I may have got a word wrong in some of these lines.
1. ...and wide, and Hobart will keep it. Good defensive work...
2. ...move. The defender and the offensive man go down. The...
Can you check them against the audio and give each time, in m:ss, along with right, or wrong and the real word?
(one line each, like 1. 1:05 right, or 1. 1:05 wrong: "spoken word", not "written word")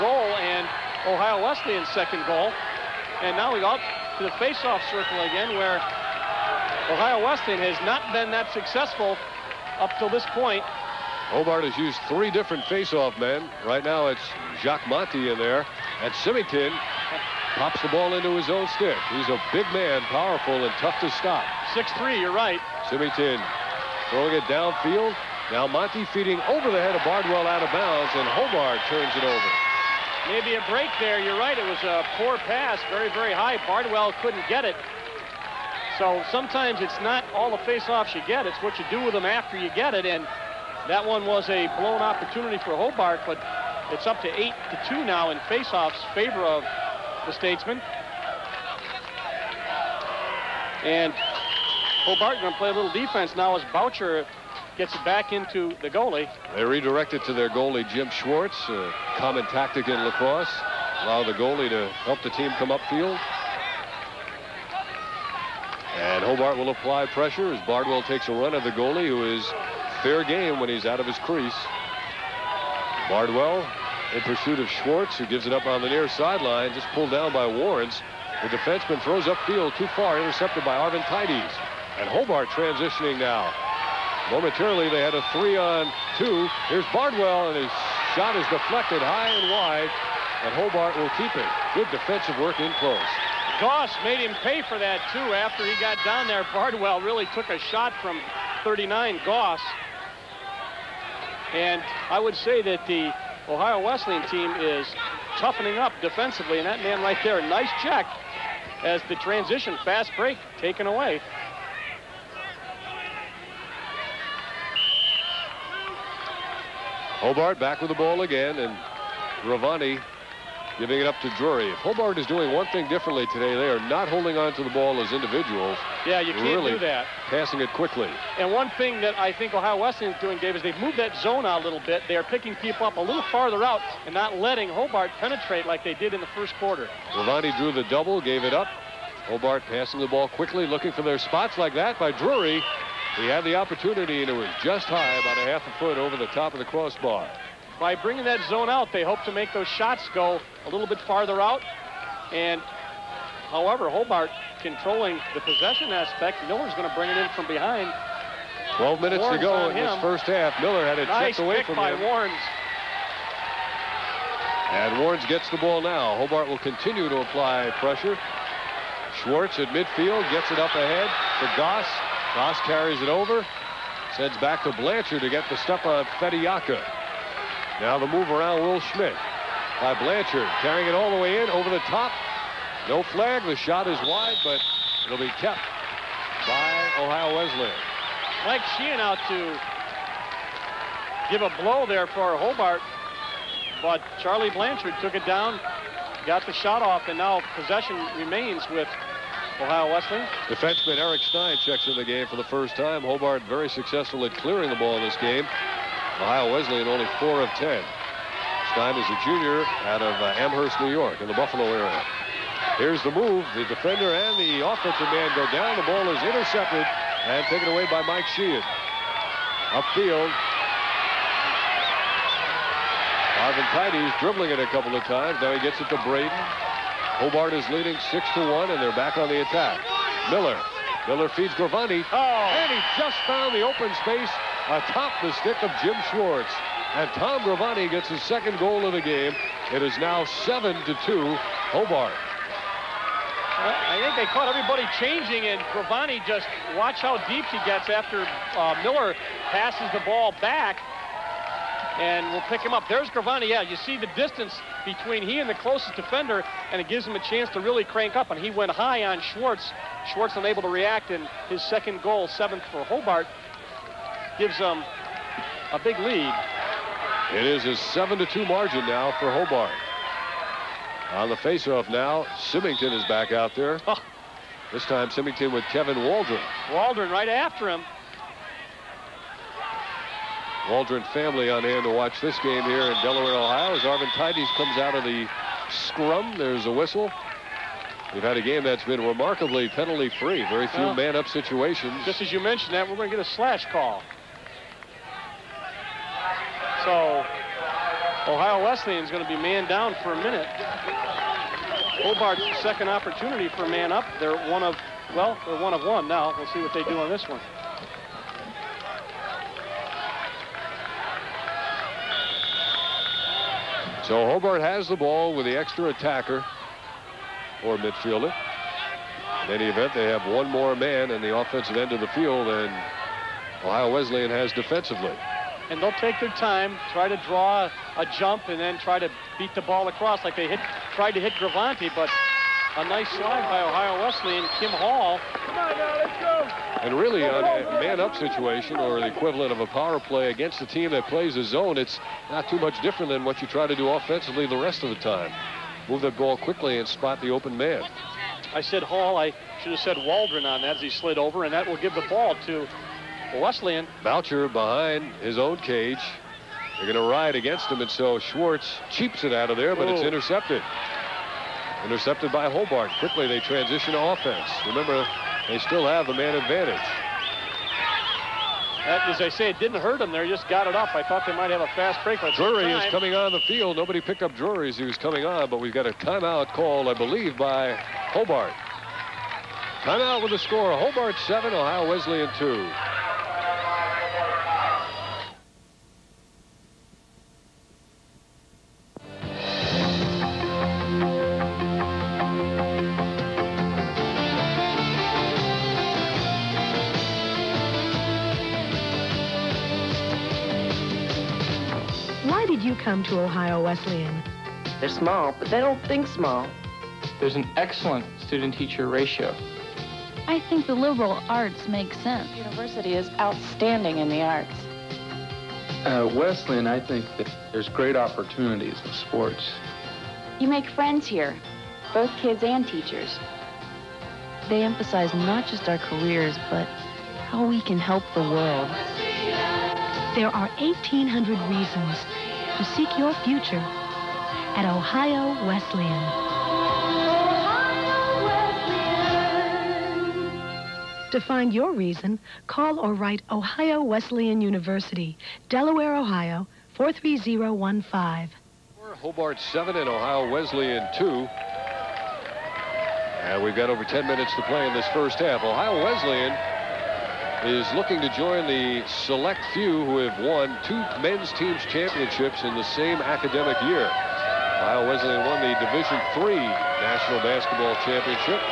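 1. 1:29 right
2. 3:33 right.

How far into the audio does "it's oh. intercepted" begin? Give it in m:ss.
5:59.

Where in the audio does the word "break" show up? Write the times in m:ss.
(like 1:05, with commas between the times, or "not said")
0:30, 1:50, 6:12.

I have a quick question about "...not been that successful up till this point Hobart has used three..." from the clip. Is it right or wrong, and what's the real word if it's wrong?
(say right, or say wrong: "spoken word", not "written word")
right.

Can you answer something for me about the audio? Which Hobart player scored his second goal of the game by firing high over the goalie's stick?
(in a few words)
Tom Gravante.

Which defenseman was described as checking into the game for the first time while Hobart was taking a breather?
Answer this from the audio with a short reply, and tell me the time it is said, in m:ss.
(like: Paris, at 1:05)
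Eric Stein, at 3:20.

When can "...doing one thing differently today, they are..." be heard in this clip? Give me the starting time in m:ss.
2:02.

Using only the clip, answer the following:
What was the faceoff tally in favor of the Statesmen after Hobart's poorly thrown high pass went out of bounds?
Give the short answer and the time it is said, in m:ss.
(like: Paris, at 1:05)
8 to 2, at 0:44.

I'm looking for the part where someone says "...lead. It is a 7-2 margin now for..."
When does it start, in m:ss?
4:25.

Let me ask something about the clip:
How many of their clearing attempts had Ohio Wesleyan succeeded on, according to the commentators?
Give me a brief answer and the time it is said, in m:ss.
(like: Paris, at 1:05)
4 of 10, at 3:27.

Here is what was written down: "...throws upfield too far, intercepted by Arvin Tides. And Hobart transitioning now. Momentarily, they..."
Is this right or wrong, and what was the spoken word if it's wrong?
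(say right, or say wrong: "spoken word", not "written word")
right.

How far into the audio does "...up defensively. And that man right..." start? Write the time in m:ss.
1:45.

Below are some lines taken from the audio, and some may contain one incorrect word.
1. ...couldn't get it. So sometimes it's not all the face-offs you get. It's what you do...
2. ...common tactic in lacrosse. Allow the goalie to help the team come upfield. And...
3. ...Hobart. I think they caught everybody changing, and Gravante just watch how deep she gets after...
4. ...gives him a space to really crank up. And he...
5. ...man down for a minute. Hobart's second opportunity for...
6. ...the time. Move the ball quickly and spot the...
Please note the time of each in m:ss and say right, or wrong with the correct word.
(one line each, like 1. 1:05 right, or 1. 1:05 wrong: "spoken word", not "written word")
1. 0:34 right
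2. 0:59 right
3. 4:01 right
4. 4:16 wrong: "chance", not "space"
5. 4:59 right
6. 5:44 right.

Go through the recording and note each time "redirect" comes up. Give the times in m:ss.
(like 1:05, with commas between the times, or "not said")
0:56.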